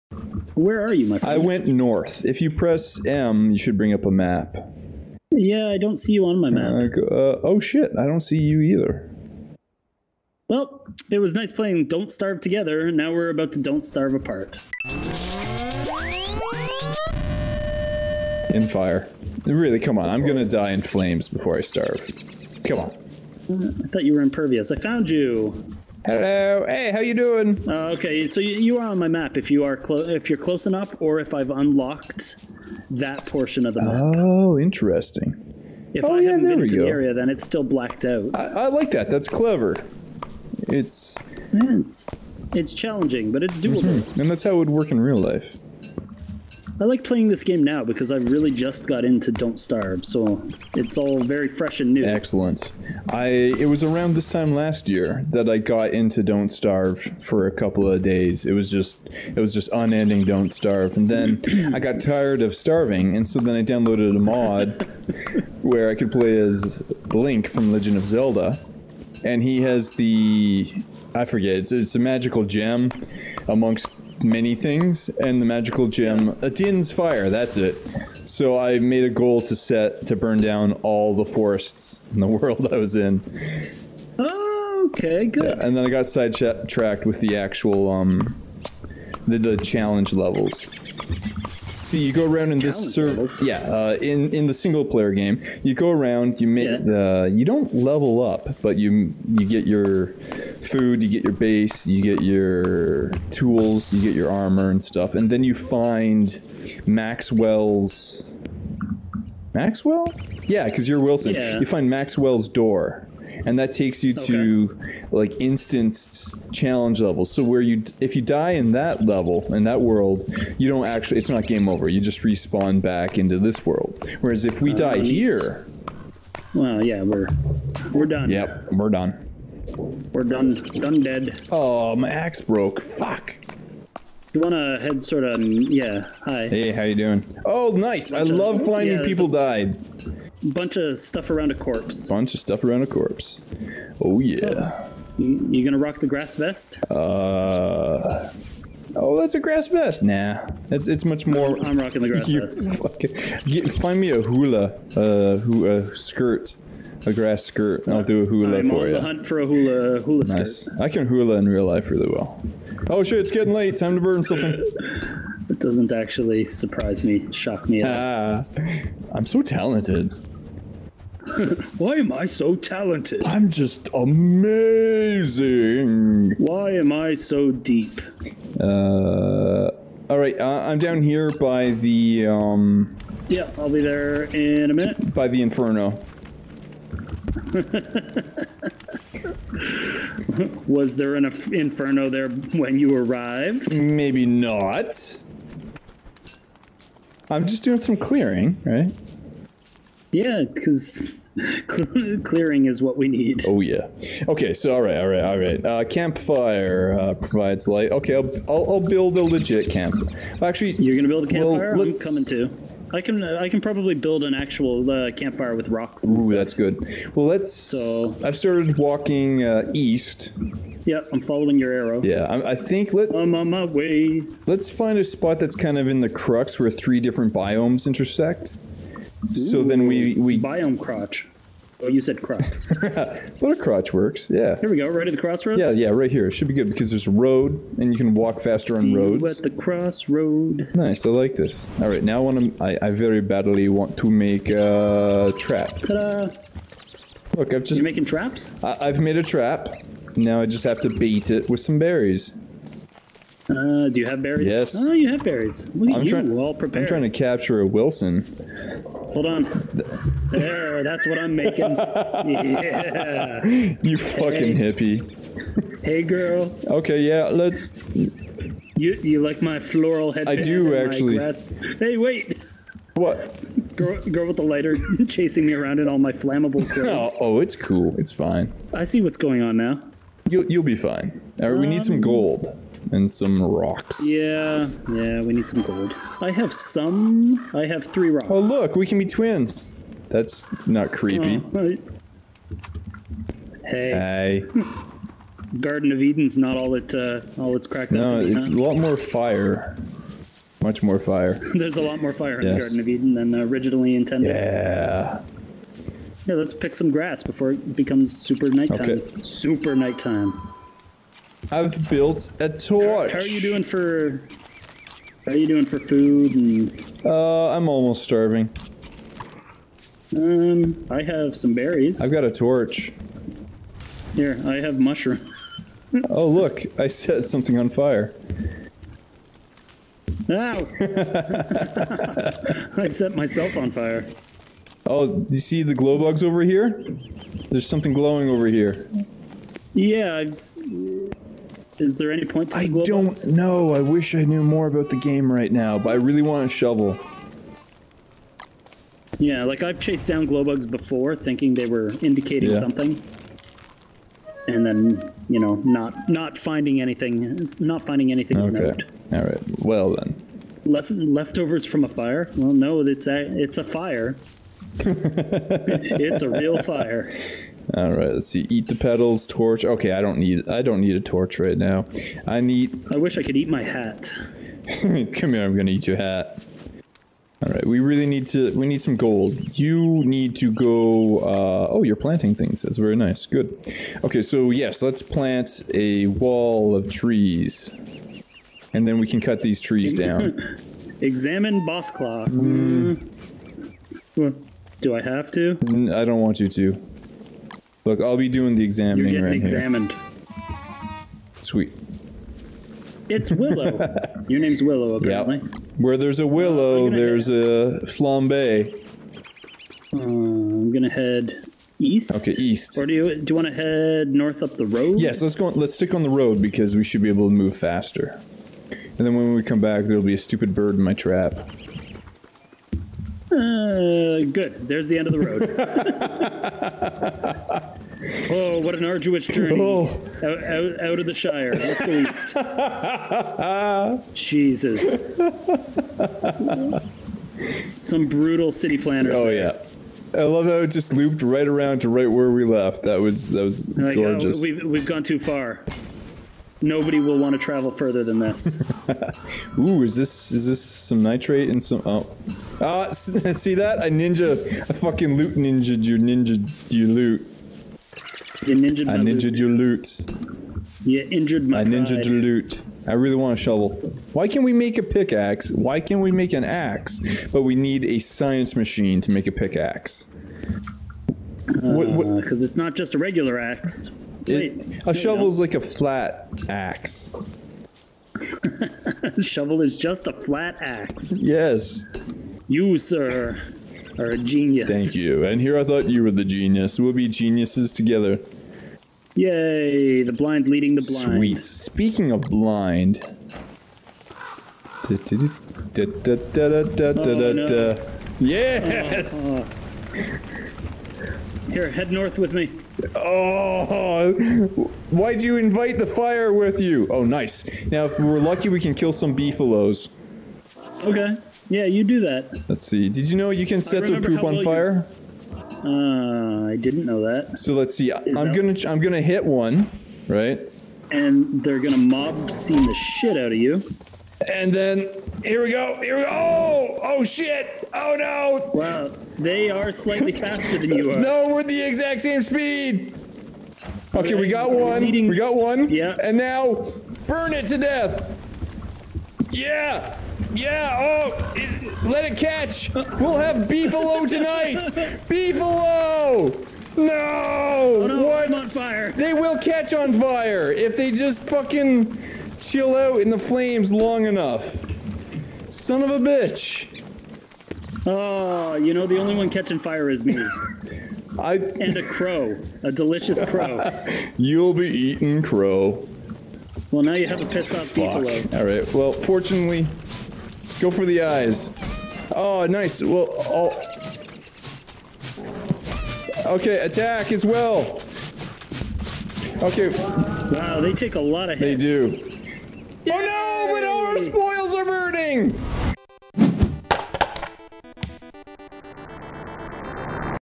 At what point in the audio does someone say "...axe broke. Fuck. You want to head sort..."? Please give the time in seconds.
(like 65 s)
132 s.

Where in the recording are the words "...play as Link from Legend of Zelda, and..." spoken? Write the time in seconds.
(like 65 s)
66 s.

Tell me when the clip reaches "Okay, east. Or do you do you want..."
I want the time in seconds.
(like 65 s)
412 s.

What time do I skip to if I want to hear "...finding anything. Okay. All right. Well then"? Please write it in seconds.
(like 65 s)
357 s.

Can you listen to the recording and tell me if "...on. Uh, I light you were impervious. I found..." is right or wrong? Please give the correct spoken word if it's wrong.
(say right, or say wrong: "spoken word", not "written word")
wrong: "thought", not "light".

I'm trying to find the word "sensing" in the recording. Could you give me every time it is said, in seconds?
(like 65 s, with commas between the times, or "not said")
not said.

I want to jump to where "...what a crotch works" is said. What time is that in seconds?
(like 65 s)
233 s.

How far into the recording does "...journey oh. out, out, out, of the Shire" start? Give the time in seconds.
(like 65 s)
429 s.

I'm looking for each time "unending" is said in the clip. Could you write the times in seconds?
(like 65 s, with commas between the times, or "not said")
59 s.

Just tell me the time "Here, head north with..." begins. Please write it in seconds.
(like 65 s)
501 s.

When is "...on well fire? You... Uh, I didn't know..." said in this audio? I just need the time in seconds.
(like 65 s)
514 s.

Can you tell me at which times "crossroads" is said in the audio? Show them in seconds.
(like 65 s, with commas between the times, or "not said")
235 s, 239 s.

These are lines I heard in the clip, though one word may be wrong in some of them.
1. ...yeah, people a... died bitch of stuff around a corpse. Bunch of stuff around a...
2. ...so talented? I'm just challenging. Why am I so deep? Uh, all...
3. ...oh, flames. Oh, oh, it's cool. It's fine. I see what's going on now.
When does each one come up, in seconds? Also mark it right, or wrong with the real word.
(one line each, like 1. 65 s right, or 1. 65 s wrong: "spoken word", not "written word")
1. 138 s wrong: "bunch", not "bitch"
2. 172 s wrong: "amazing", not "challenging"
3. 276 s wrong: "clothes", not "flames".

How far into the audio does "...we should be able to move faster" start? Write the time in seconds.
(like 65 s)
416 s.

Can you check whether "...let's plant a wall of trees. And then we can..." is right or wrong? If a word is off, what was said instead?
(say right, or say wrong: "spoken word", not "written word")
right.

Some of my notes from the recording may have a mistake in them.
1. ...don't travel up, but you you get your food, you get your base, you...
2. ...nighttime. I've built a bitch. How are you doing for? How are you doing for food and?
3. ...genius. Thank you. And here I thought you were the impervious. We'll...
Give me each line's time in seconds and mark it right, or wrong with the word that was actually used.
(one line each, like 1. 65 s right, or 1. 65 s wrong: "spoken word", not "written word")
1. 97 s wrong: "level", not "travel"
2. 309 s wrong: "torch", not "bitch"
3. 484 s wrong: "genius", not "impervious".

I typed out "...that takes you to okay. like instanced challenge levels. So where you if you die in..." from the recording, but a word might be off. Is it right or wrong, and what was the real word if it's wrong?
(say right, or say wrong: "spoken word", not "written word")
right.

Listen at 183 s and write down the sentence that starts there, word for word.
Yeah, I'll be there in a minute.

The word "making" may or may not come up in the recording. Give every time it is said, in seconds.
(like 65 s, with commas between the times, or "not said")
247 s, 261 s.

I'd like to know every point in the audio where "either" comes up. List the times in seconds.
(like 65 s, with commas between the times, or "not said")
8 s.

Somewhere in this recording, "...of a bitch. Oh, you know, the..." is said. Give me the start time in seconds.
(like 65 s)
555 s.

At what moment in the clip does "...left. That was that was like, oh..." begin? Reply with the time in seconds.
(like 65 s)
442 s.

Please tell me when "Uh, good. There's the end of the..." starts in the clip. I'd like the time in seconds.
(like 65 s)
423 s.